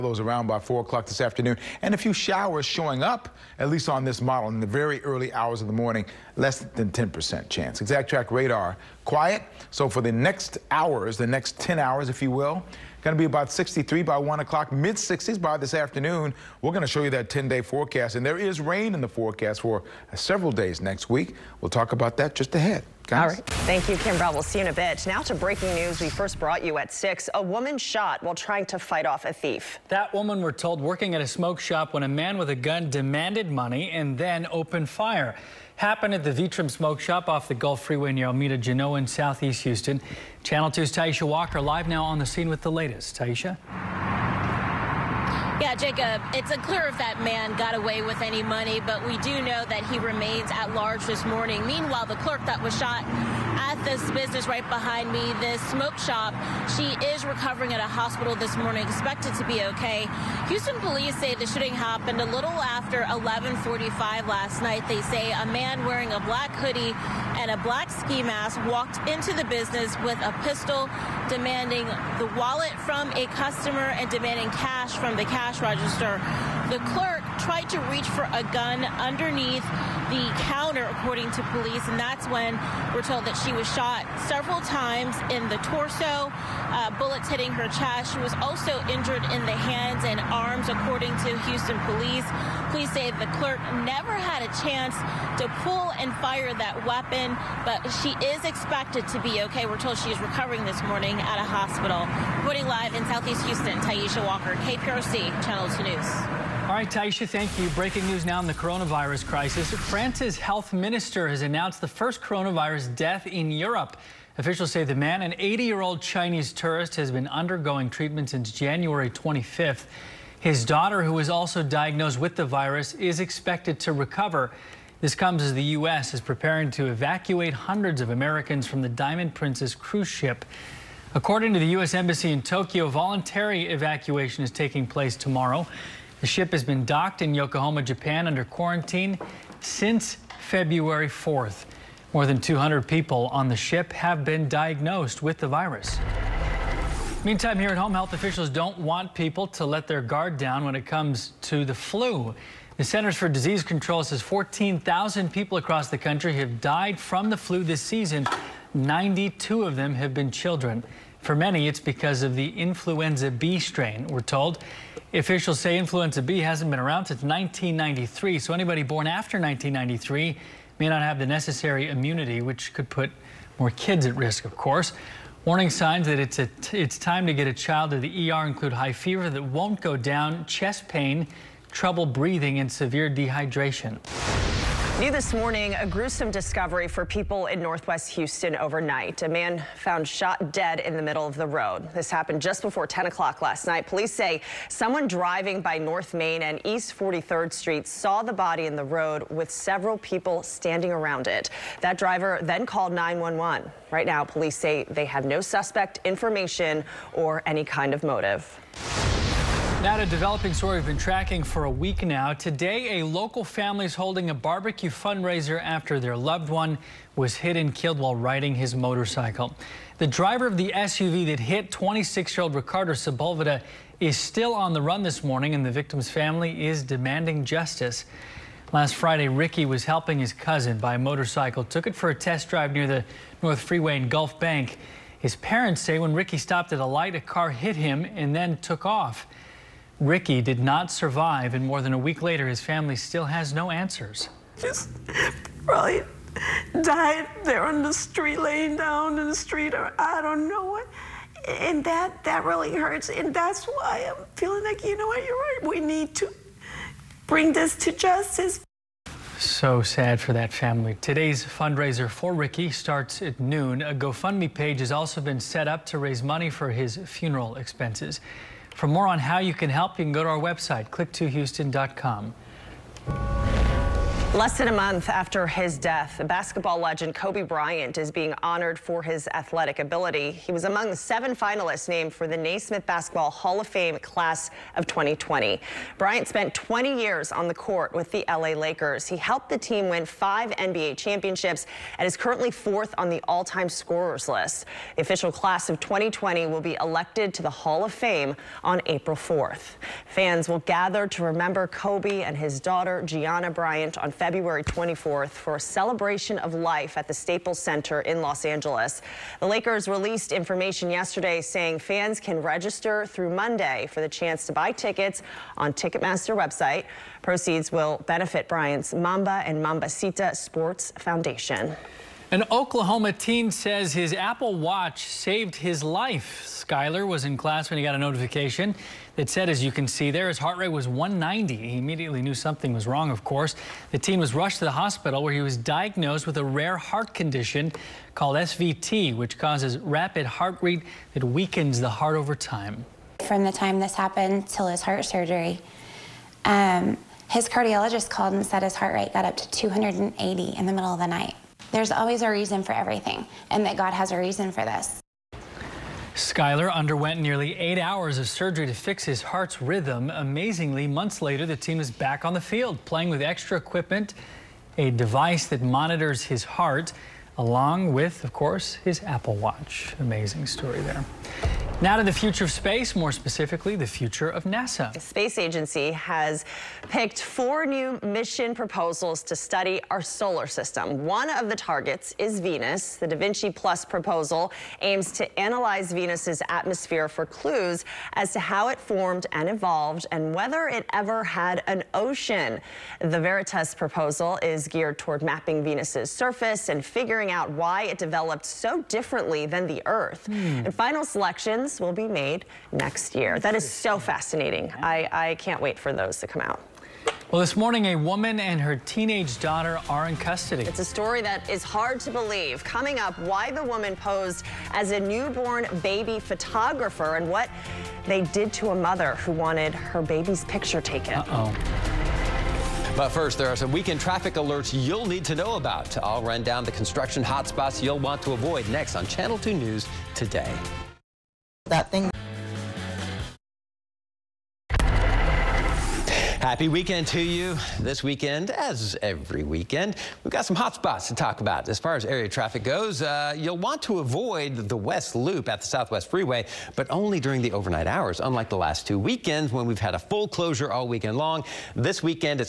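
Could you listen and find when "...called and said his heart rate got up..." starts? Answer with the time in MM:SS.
05:48.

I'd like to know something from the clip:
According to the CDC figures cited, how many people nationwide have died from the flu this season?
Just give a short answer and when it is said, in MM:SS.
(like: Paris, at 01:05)
14,000, at 02:34.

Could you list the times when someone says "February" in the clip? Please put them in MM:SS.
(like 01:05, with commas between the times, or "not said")
02:20, 05:04.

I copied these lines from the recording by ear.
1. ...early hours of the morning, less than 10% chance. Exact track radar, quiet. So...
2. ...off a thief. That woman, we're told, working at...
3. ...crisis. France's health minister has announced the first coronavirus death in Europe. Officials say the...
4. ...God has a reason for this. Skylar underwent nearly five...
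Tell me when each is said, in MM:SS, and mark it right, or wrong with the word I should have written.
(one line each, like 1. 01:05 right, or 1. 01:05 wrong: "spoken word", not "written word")
1. 00:05 right
2. 00:29 right
3. 01:49 right
4. 05:53 wrong: "eight", not "five".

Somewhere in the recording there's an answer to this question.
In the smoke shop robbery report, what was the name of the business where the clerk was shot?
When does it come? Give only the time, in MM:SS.
00:36.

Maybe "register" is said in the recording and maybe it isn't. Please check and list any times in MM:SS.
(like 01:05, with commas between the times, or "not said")
01:15, 05:12.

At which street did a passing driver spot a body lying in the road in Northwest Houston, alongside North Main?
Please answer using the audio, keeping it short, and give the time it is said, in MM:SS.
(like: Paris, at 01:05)
East 43rd Street, at 03:16.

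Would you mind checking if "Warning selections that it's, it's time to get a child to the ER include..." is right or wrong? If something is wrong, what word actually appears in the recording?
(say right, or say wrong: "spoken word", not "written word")
wrong: "signs", not "selections".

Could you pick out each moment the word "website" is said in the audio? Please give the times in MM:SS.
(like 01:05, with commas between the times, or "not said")
04:30, 05:16.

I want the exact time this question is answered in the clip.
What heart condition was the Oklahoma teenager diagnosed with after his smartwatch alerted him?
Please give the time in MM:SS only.
05:38.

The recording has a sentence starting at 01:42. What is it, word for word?
Reporting live in Southeast Houston, Taisha Walker, KPRC, Channel 2 News.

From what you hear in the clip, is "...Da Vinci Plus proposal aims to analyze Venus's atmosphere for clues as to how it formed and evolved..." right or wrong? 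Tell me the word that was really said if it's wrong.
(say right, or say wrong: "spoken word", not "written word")
right.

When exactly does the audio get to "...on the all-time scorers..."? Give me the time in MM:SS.
04:52.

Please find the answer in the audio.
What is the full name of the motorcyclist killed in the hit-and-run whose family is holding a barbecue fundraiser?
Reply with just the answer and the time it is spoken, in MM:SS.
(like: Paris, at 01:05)
Ricardo Sepulveda, at 03:42.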